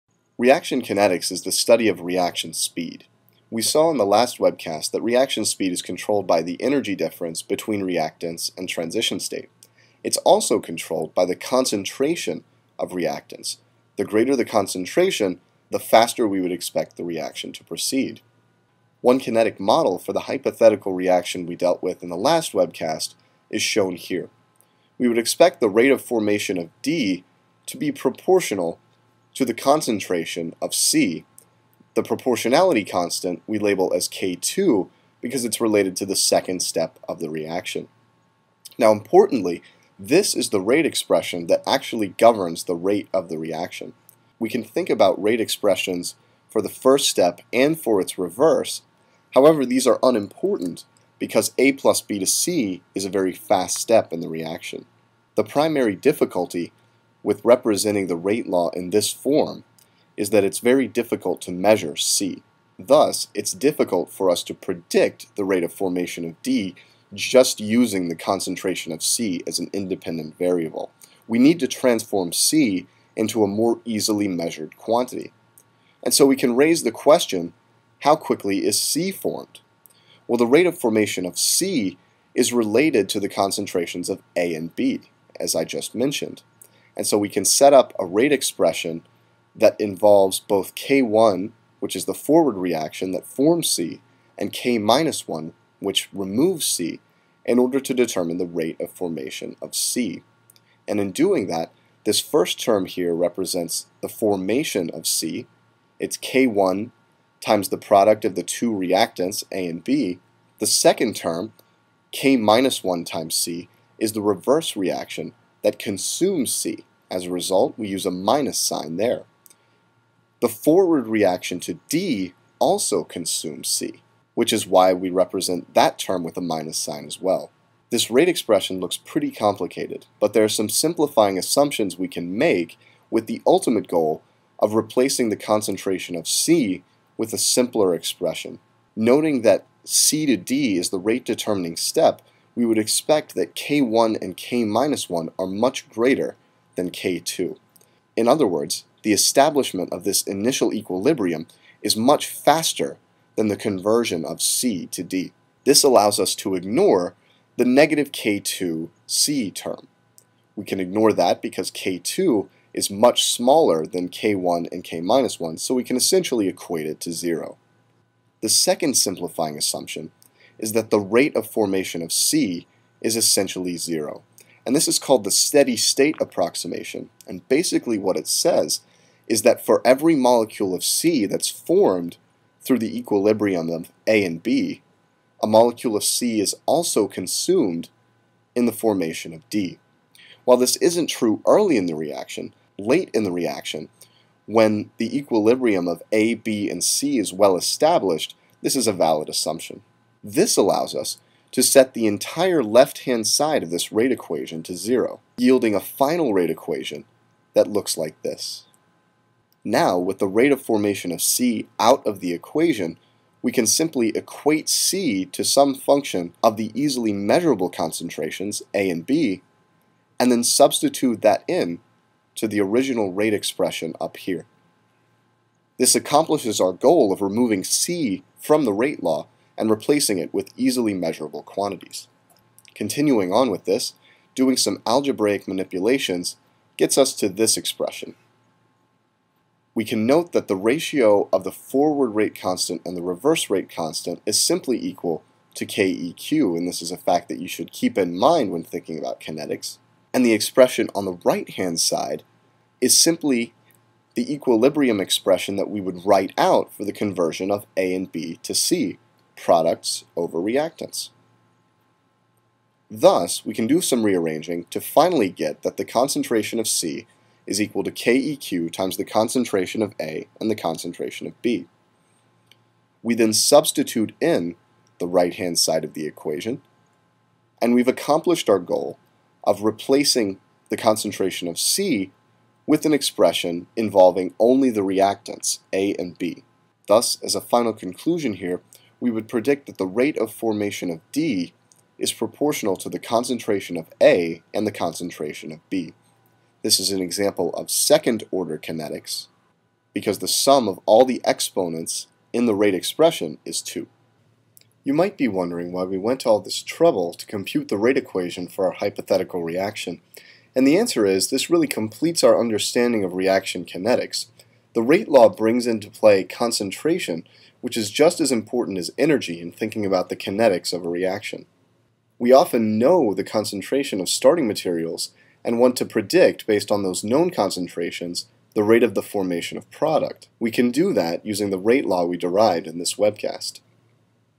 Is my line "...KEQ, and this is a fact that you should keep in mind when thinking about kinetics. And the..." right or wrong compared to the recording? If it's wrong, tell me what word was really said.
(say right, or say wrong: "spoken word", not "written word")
right.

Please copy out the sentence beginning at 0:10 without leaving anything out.
It's also controlled by the concentration of reactants.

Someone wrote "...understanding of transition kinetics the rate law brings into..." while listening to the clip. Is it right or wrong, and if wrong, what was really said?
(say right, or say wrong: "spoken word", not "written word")
wrong: "reaction", not "transition".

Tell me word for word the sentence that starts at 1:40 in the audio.
And in doing that, this first term here represents the formation of C.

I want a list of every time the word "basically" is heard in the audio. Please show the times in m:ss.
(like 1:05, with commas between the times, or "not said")
2:57.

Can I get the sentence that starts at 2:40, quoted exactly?
We can ignore that because k2 is much smaller than k1 and k-1, so we can essentially equate it to zero.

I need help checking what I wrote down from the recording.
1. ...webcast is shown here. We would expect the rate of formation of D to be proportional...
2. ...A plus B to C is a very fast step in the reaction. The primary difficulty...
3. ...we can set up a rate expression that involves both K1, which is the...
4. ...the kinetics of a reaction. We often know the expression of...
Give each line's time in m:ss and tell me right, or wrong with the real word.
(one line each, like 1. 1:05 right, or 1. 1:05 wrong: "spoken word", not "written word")
1. 0:22 right
2. 0:51 right
3. 1:27 right
4. 5:20 wrong: "concentration", not "expression".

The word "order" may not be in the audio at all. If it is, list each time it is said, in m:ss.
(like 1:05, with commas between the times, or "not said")
1:37, 4:58.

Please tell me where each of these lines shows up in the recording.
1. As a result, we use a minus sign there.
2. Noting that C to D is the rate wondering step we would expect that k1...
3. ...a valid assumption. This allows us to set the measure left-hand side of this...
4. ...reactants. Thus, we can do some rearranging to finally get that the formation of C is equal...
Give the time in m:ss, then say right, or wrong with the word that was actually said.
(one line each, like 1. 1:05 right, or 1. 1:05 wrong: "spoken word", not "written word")
1. 1:57 right
2. 2:18 wrong: "determining", not "wondering"
3. 3:18 wrong: "entire", not "measure"
4. 4:20 wrong: "concentration", not "formation".